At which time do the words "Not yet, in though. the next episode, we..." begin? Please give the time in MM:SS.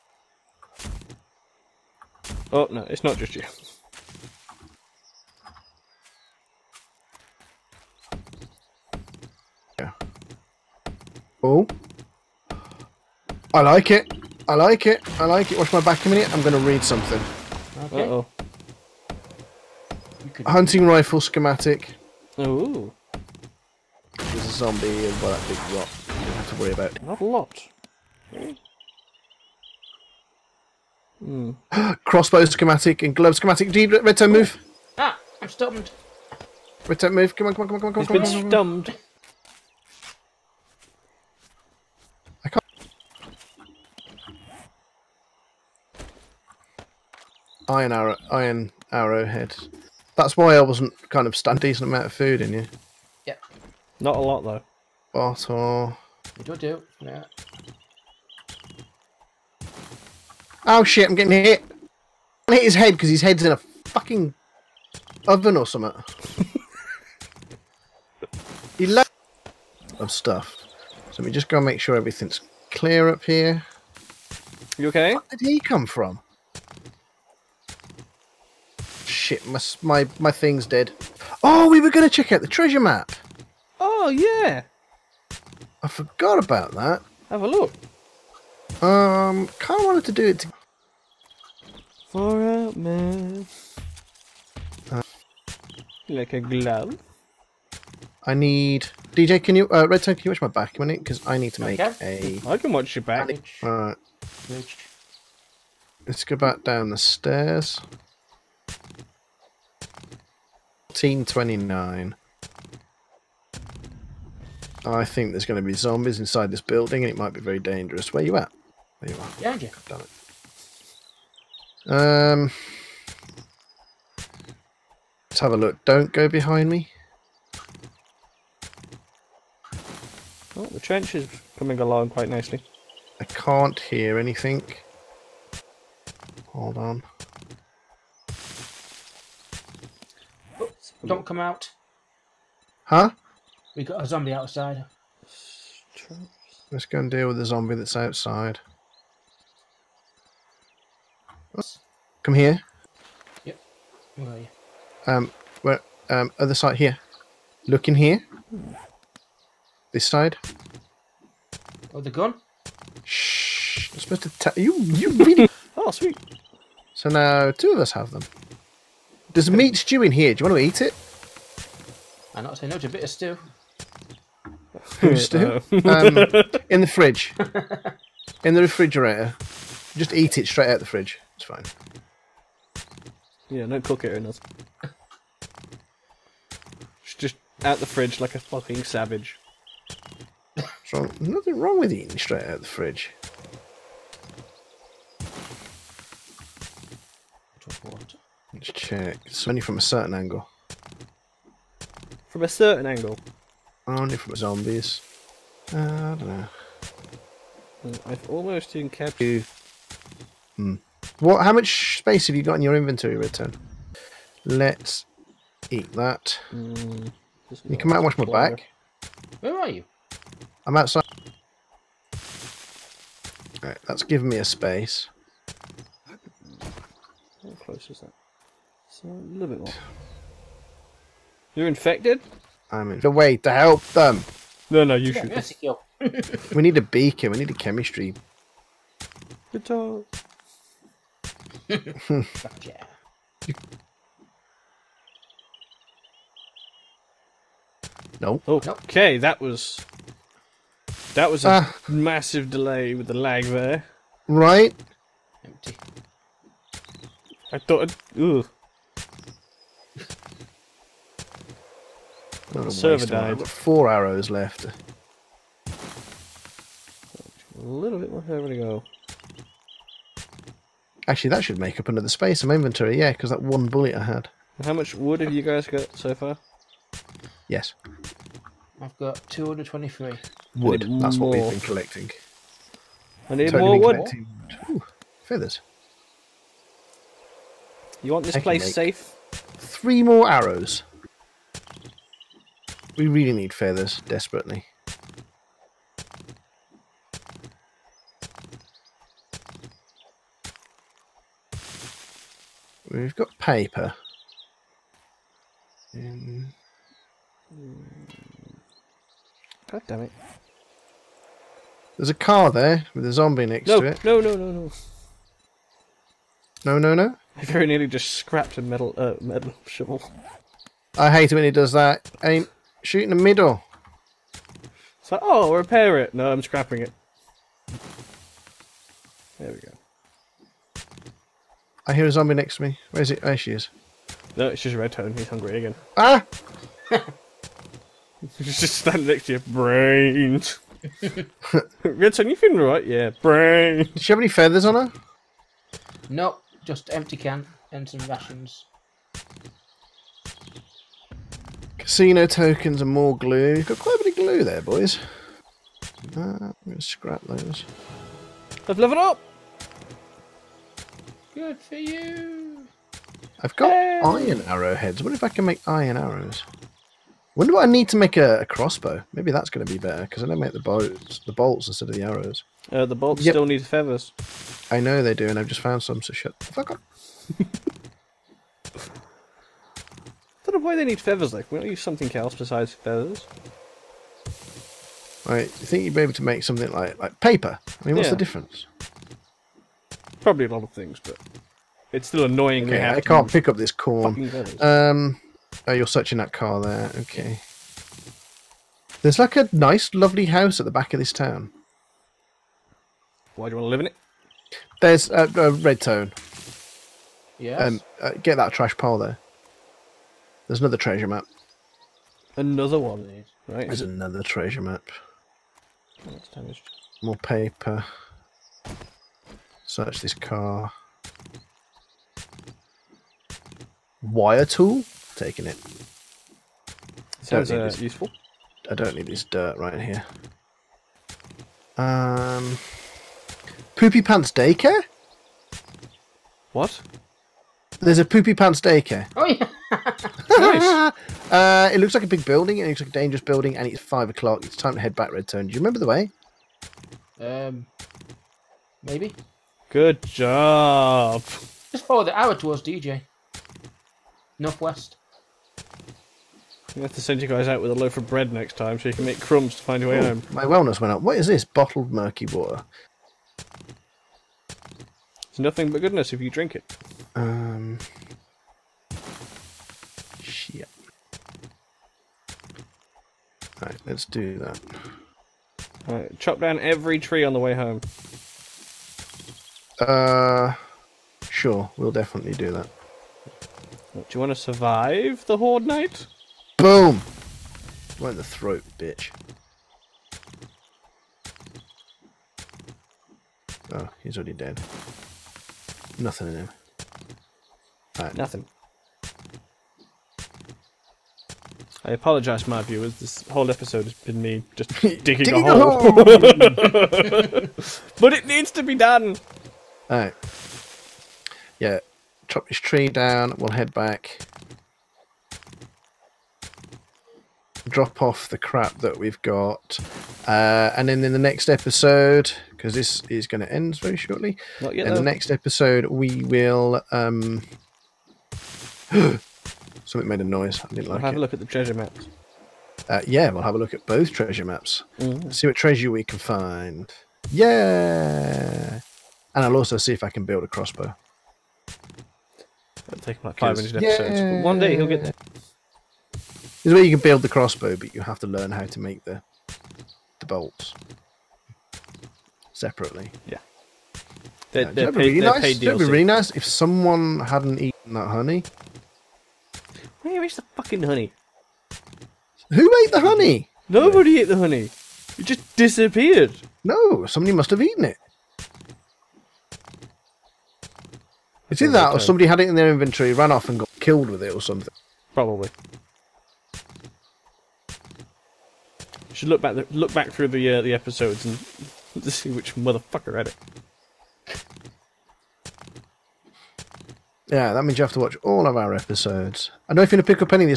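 08:44.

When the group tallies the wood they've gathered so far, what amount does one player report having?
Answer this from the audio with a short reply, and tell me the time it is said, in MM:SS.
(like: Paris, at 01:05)
223, at 04:39.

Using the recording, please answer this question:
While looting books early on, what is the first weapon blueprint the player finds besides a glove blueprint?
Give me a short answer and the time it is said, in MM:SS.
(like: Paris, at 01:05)
Hunting rifle schematic, at 00:20.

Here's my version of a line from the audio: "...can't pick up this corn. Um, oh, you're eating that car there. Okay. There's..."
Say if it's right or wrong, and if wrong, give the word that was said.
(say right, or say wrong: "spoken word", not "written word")
wrong: "searching", not "eating".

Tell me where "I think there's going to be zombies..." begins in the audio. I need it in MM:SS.
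01:54.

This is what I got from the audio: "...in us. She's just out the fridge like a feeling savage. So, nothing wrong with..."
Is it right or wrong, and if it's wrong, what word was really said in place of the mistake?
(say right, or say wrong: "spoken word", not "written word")
wrong: "fucking", not "feeling".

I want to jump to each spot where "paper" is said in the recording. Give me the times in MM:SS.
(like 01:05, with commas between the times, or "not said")
05:03, 06:27, 06:57.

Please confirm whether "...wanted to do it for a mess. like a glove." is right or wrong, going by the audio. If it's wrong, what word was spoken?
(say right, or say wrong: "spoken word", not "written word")
right.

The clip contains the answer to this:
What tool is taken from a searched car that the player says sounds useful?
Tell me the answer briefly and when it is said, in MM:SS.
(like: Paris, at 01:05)
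Wire tool, at 07:04.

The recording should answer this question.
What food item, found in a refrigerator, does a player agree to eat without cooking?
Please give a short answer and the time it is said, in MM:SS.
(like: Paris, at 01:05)
meat stew, at 02:49.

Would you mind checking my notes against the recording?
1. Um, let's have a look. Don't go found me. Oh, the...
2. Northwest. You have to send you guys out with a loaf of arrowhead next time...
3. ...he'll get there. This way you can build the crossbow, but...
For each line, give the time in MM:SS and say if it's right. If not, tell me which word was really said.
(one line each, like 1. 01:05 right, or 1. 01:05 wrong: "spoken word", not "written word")
1. 02:01 wrong: "behind", not "found"
2. 07:34 wrong: "bread", not "arrowhead"
3. 09:04 right.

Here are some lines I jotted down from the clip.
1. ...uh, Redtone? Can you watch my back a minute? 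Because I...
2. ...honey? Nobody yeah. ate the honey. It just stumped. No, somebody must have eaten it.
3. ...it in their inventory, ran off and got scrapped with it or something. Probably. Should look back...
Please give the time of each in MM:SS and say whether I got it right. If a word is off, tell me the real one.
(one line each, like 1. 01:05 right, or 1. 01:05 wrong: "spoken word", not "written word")
1. 01:39 right
2. 09:22 wrong: "disappeared", not "stumped"
3. 09:32 wrong: "killed", not "scrapped".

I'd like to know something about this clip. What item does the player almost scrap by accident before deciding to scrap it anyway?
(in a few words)
metal shovel.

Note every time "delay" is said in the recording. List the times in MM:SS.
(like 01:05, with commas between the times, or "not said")
04:12.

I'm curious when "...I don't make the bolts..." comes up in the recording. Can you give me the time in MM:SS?
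06:10.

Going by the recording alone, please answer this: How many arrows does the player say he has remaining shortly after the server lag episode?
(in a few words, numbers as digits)
4.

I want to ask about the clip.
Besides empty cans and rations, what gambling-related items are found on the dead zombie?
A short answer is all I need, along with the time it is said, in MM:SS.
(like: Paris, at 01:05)
Casino tokens, at 05:51.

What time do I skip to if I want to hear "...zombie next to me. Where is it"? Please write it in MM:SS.
05:32.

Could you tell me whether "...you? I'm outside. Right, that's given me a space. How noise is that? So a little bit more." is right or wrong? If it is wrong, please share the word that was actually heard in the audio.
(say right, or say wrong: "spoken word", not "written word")
wrong: "close", not "noise".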